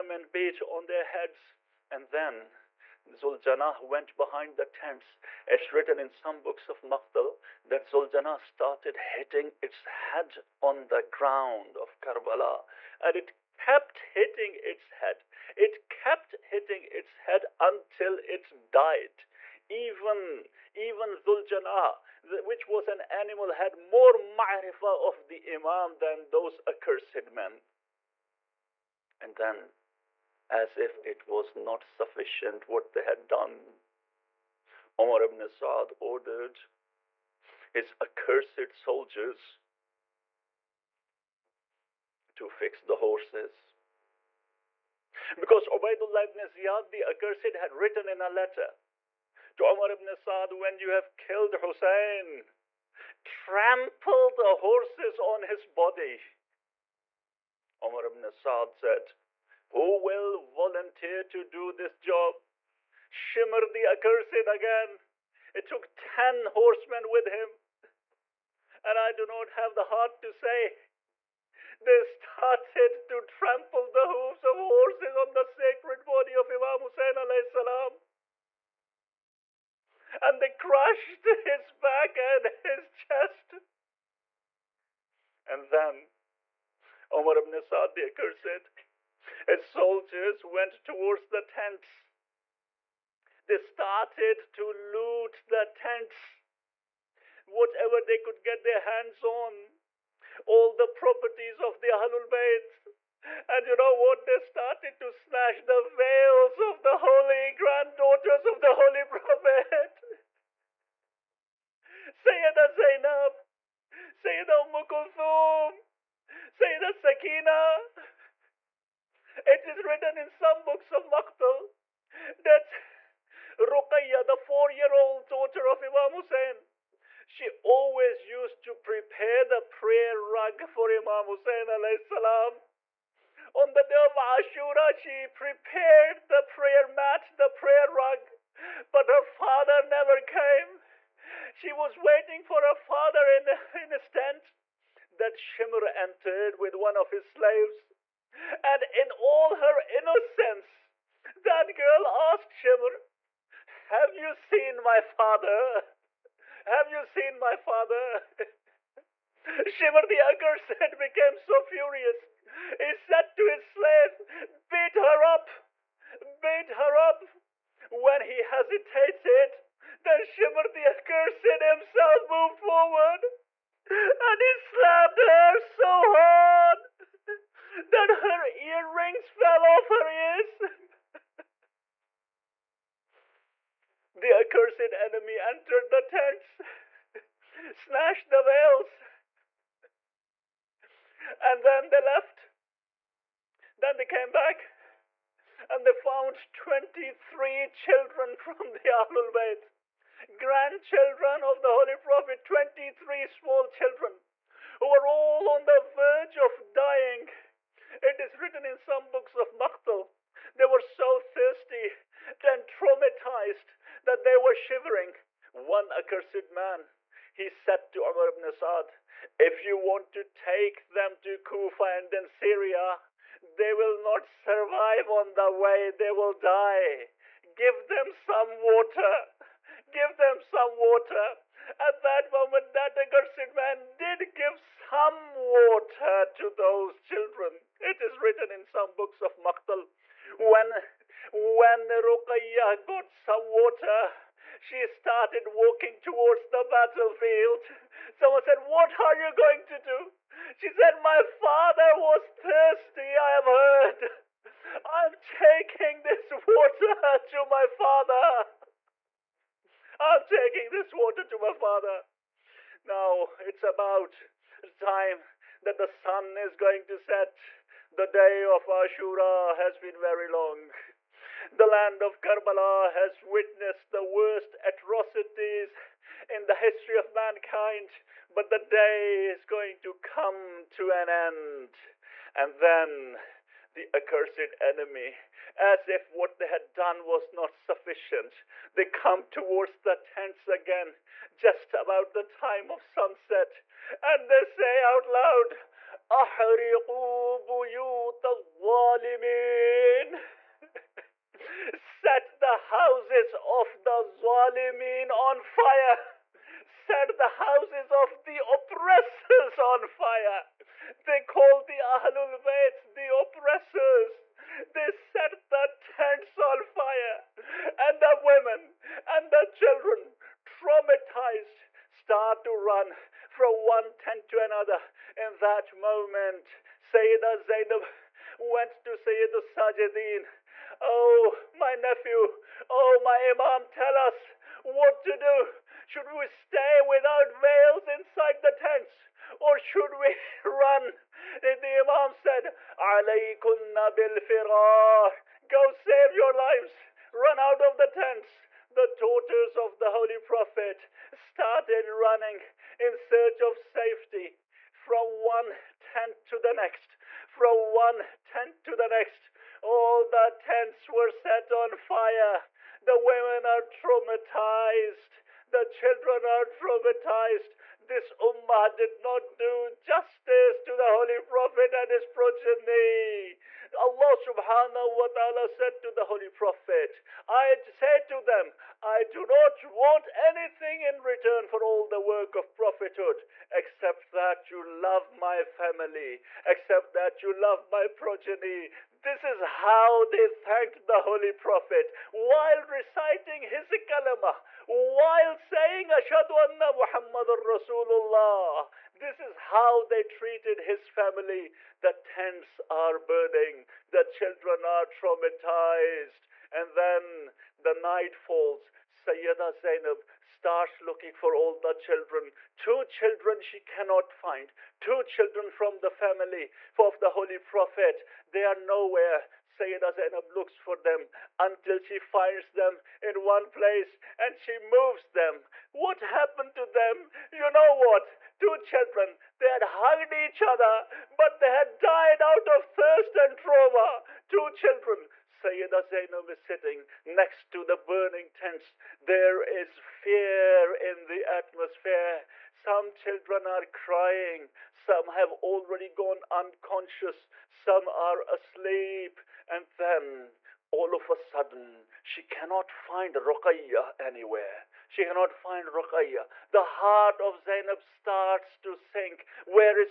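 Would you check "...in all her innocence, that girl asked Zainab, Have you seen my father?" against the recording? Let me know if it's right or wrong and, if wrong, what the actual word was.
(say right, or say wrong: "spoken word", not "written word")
wrong: "Shimr", not "Zainab".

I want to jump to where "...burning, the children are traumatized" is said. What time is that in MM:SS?
06:42.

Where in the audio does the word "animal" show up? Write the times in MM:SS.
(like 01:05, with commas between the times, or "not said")
00:23.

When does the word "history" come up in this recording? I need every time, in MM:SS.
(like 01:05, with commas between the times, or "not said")
04:36.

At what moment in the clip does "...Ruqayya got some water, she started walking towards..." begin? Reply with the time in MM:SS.
04:01.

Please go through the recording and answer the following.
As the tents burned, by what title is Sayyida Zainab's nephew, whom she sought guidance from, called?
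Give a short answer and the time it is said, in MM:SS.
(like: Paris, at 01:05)
Sayyidus Sajidin, at 05:28.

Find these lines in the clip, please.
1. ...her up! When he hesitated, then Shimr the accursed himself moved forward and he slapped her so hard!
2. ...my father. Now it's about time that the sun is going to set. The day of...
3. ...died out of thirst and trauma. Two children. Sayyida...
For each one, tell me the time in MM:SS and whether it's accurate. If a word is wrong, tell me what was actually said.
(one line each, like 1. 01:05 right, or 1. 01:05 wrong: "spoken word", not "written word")
1. 02:46 right
2. 04:21 right
3. 07:11 right.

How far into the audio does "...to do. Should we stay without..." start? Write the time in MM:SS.
05:35.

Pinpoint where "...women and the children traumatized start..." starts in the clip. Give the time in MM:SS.
05:18.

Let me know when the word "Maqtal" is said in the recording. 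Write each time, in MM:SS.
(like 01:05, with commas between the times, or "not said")
00:06, 02:01, 03:29, 03:59.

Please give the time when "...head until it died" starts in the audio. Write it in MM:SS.
00:17.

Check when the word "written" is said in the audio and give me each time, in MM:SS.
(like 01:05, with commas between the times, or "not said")
00:05, 00:47, 01:59, 03:28, 03:58.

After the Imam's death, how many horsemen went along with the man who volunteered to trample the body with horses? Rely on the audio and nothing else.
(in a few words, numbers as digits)
10.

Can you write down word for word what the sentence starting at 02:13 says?
On the day of Ashura, she prepared the prayer mat, the prayer rug, but her father never came.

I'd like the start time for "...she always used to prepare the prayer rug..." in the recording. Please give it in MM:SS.
02:07.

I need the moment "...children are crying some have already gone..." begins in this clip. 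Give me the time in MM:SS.
07:22.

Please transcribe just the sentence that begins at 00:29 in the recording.
And then as if it was not sufficient what they had done.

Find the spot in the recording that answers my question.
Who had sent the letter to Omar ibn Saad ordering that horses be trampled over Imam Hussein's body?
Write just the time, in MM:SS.
00:45.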